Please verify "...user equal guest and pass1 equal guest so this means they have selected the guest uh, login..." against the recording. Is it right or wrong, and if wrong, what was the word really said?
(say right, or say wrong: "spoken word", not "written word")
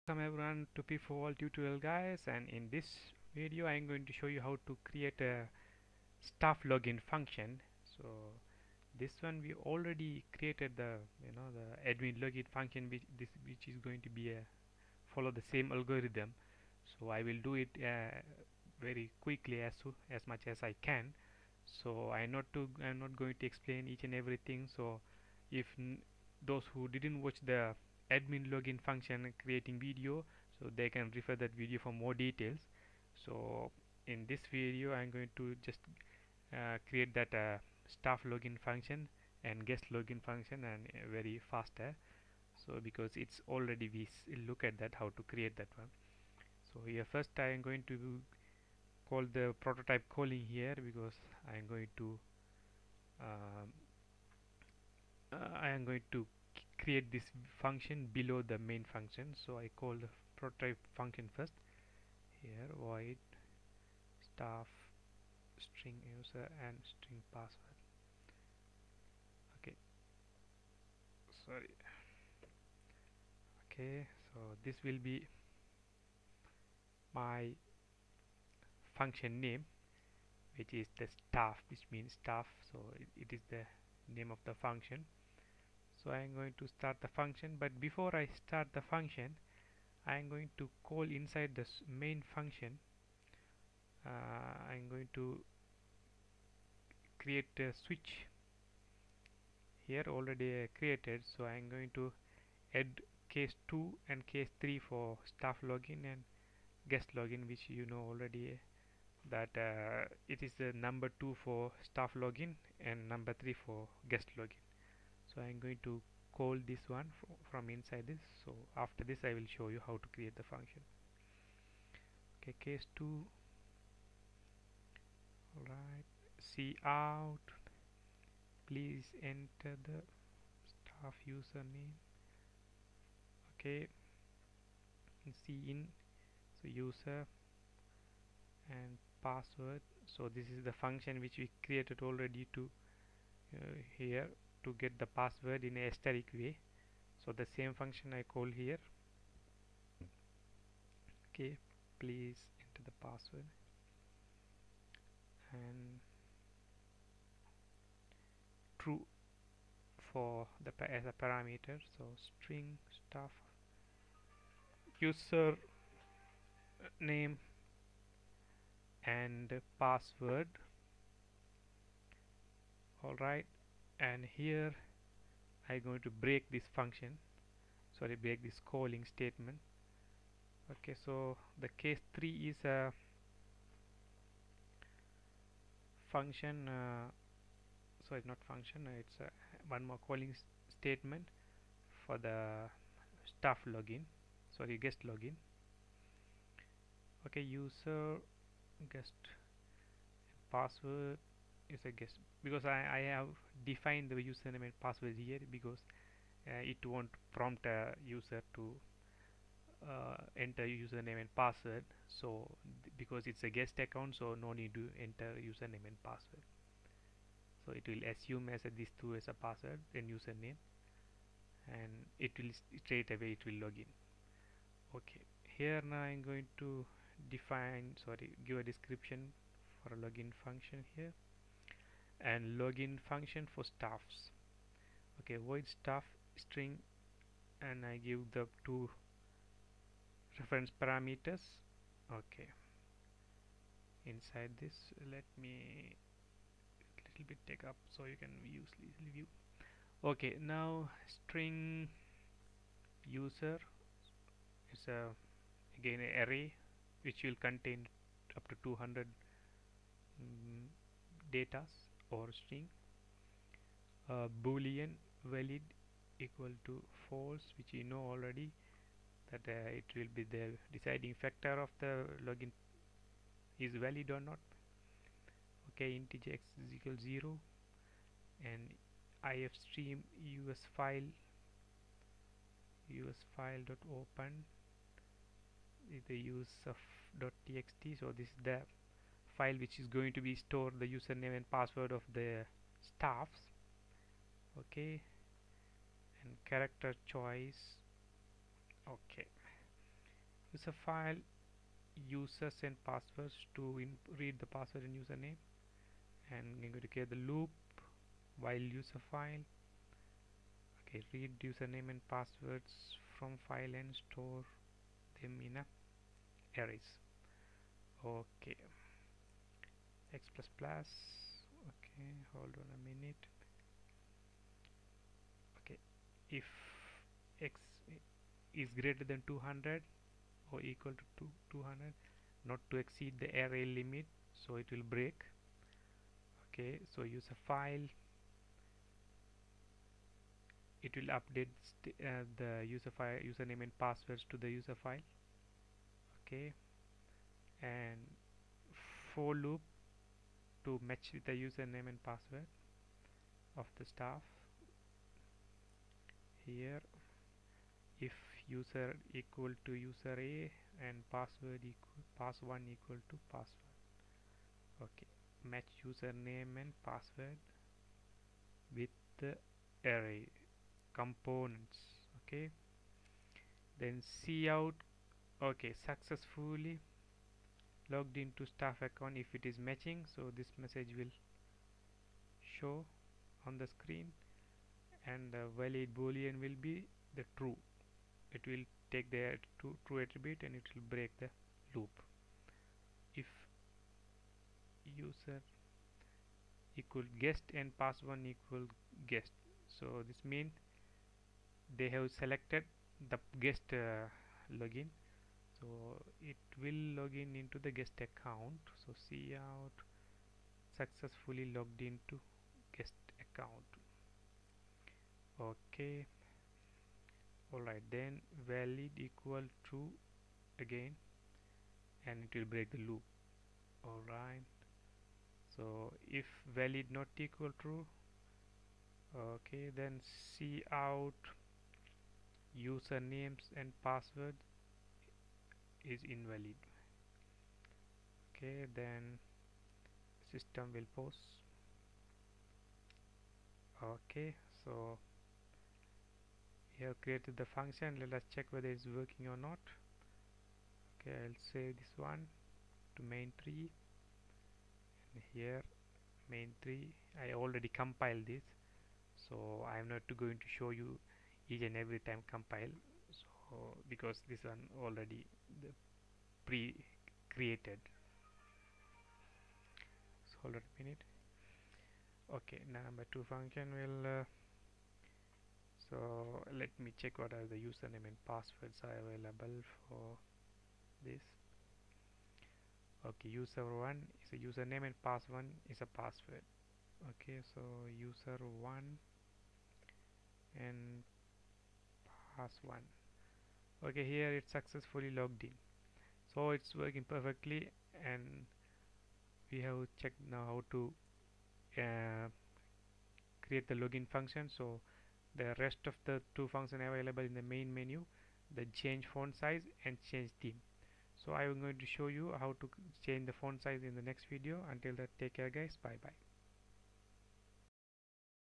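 right.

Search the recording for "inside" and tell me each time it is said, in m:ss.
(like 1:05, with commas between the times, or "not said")
1:31, 1:57, 4:04.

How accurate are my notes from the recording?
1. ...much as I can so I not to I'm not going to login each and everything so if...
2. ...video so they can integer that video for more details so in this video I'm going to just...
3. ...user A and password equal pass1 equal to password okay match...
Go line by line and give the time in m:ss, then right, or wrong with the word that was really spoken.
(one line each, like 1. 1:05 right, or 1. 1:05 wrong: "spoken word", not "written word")
1. 0:20 wrong: "explain", not "login"
2. 0:29 wrong: "refer", not "integer"
3. 5:59 right.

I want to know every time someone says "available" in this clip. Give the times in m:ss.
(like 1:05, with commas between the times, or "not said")
7:59, 8:26.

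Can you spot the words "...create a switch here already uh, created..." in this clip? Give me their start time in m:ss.
1:37.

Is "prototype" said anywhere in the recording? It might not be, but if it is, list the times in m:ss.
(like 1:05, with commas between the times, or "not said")
0:49, 1:00.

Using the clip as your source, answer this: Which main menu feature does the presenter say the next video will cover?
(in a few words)
change font size.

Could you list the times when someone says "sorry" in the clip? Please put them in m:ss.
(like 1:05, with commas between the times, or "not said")
1:11, 2:57, 3:14, 3:48.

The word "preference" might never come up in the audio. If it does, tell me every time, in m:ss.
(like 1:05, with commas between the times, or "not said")
not said.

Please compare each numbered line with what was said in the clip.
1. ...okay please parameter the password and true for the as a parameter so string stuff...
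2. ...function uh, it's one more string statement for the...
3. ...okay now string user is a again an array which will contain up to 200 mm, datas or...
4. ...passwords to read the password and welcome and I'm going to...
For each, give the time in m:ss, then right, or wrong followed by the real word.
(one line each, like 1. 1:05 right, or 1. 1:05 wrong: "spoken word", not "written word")
1. 2:31 wrong: "enter", not "parameter"
2. 3:08 wrong: "calling", not "string"
3. 4:10 right
4. 5:02 wrong: "username", not "welcome".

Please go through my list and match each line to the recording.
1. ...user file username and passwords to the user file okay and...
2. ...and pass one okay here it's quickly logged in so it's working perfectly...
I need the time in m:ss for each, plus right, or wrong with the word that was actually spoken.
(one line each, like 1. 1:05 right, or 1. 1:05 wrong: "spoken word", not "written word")
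1. 5:42 right
2. 8:10 wrong: "successfully", not "quickly".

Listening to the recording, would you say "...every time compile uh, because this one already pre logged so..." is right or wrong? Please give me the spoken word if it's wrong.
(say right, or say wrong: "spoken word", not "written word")
wrong: "created", not "logged".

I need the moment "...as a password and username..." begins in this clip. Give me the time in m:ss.
3:39.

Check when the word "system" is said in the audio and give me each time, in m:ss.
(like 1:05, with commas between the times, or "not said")
7:20.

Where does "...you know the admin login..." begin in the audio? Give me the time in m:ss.
0:11.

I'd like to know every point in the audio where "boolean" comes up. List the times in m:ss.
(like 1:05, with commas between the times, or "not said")
4:24, 6:25.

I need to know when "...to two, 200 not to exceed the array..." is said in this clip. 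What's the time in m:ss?
5:30.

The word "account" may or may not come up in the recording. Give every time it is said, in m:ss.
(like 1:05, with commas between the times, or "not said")
3:33, 6:18, 6:48, 6:53.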